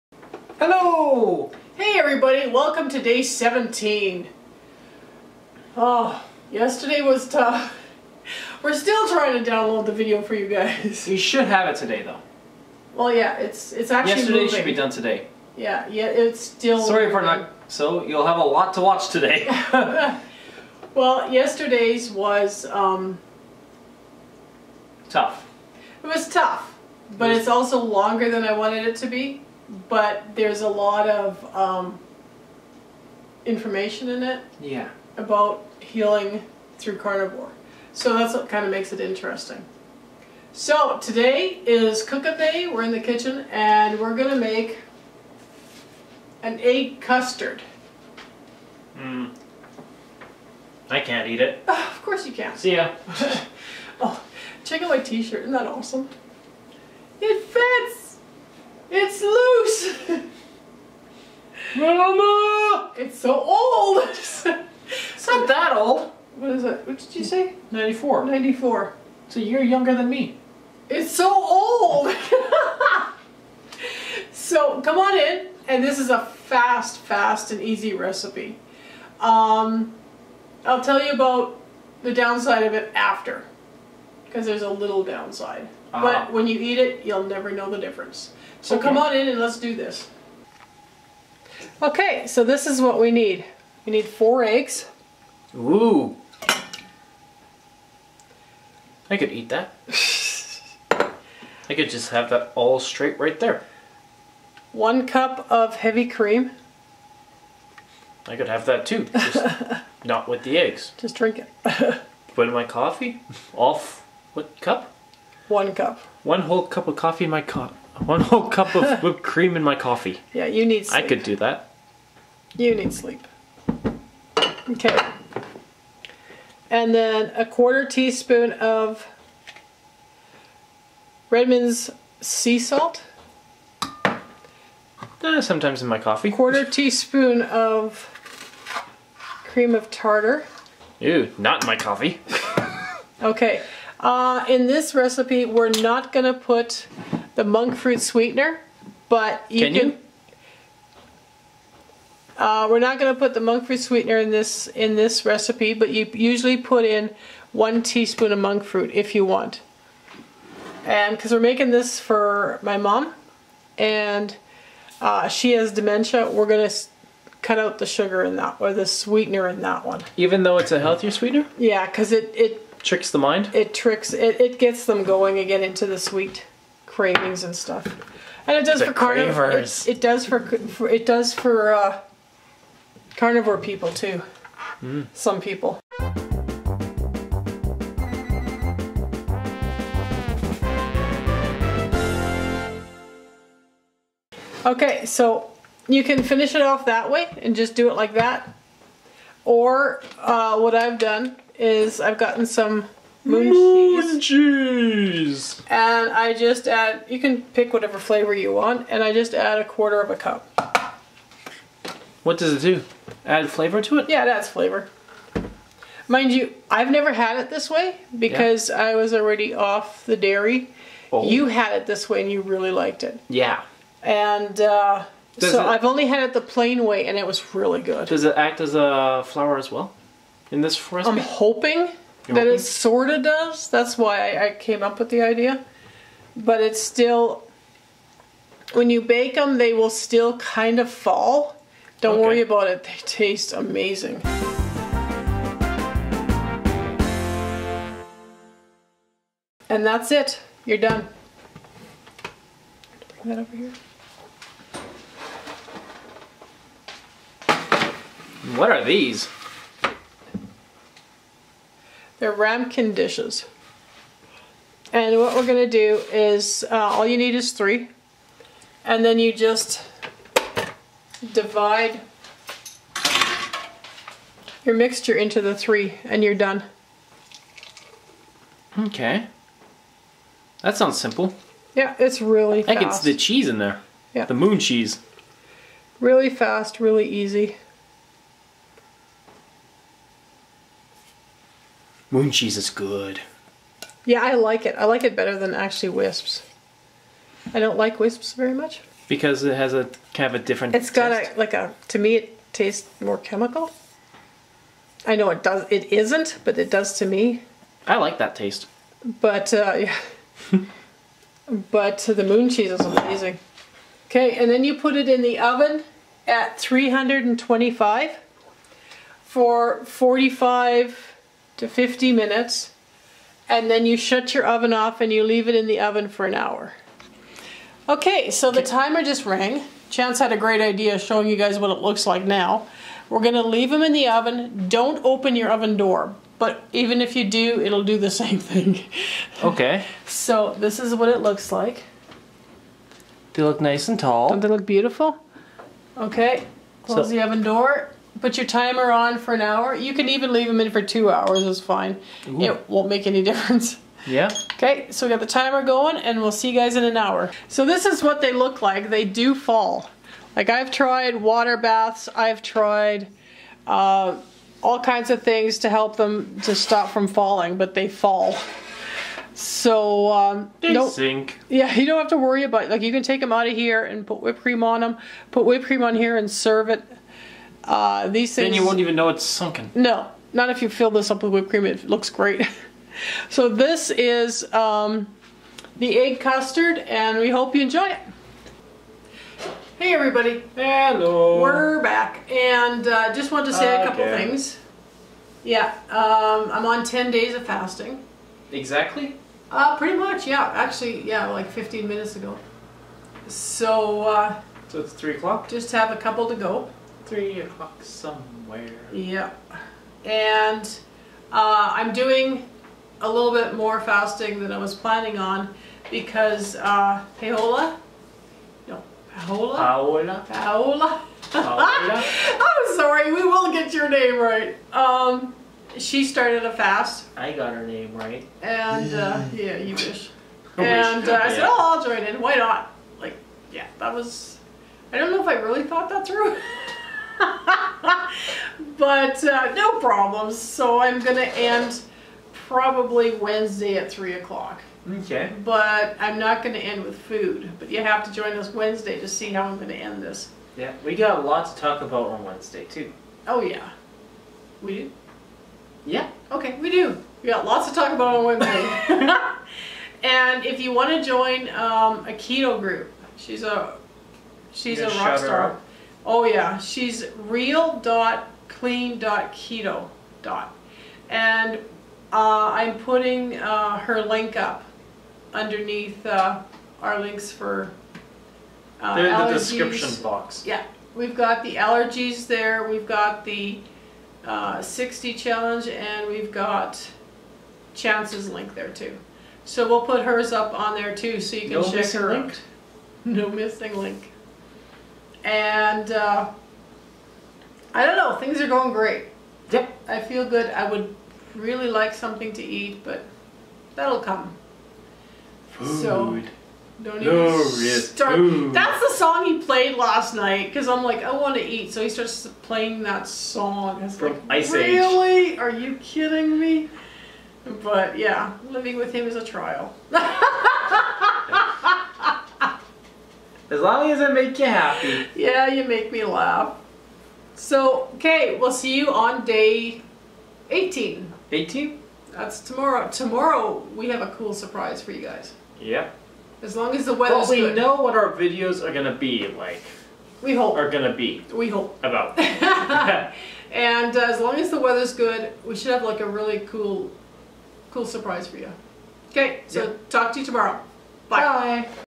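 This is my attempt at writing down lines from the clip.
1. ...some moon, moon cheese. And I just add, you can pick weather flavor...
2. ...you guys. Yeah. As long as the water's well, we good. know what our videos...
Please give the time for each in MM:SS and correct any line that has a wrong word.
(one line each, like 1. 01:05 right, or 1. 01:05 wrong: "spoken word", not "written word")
1. 03:22 wrong: "whatever", not "weather"
2. 08:54 wrong: "weather", not "water".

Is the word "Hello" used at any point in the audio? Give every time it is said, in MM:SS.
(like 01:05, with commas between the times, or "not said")
00:00, 06:30.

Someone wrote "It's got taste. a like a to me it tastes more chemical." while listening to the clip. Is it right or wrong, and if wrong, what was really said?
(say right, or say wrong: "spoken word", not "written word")
right.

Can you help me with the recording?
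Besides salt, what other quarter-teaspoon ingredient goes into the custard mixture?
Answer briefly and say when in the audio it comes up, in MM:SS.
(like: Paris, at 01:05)
Cream of tartar, at 02:19.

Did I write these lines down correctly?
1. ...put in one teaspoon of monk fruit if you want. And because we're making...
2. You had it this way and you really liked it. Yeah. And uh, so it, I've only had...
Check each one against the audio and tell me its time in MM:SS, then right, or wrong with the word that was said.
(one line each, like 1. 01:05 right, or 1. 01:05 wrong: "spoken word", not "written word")
1. 02:36 right
2. 03:41 right.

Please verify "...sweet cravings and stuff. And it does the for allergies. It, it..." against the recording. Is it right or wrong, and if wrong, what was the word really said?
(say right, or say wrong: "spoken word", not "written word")
wrong: "carnivores", not "allergies".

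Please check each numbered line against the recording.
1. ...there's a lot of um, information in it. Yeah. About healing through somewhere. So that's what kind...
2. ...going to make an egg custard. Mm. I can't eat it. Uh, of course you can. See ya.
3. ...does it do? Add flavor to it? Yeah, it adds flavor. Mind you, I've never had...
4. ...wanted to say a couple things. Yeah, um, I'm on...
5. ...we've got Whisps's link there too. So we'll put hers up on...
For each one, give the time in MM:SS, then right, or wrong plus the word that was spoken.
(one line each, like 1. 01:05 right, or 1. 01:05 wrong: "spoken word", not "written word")
1. 00:30 wrong: "carnivore", not "somewhere"
2. 00:44 right
3. 03:32 right
4. 06:33 right
5. 08:06 wrong: "Chance", not "Whisps".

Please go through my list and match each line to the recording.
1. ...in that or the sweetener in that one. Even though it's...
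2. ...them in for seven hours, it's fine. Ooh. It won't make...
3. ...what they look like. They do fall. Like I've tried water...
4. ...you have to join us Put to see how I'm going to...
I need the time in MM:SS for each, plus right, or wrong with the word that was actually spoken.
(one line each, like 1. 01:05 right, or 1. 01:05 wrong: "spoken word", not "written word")
1. 02:48 right
2. 05:50 wrong: "two", not "seven"
3. 05:58 right
4. 07:27 wrong: "Wednesday", not "Put".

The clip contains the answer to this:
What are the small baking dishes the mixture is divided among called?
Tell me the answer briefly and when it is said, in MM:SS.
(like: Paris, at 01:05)
Ramekin dishes, at 04:22.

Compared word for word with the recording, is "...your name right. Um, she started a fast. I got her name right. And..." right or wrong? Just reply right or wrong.
right.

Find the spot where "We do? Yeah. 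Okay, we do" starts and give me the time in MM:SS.
07:34.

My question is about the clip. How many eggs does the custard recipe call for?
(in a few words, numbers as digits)
4.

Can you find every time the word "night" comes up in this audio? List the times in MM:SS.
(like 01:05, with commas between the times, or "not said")
08:30.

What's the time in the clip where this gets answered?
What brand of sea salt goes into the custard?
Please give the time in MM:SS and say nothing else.
02:11.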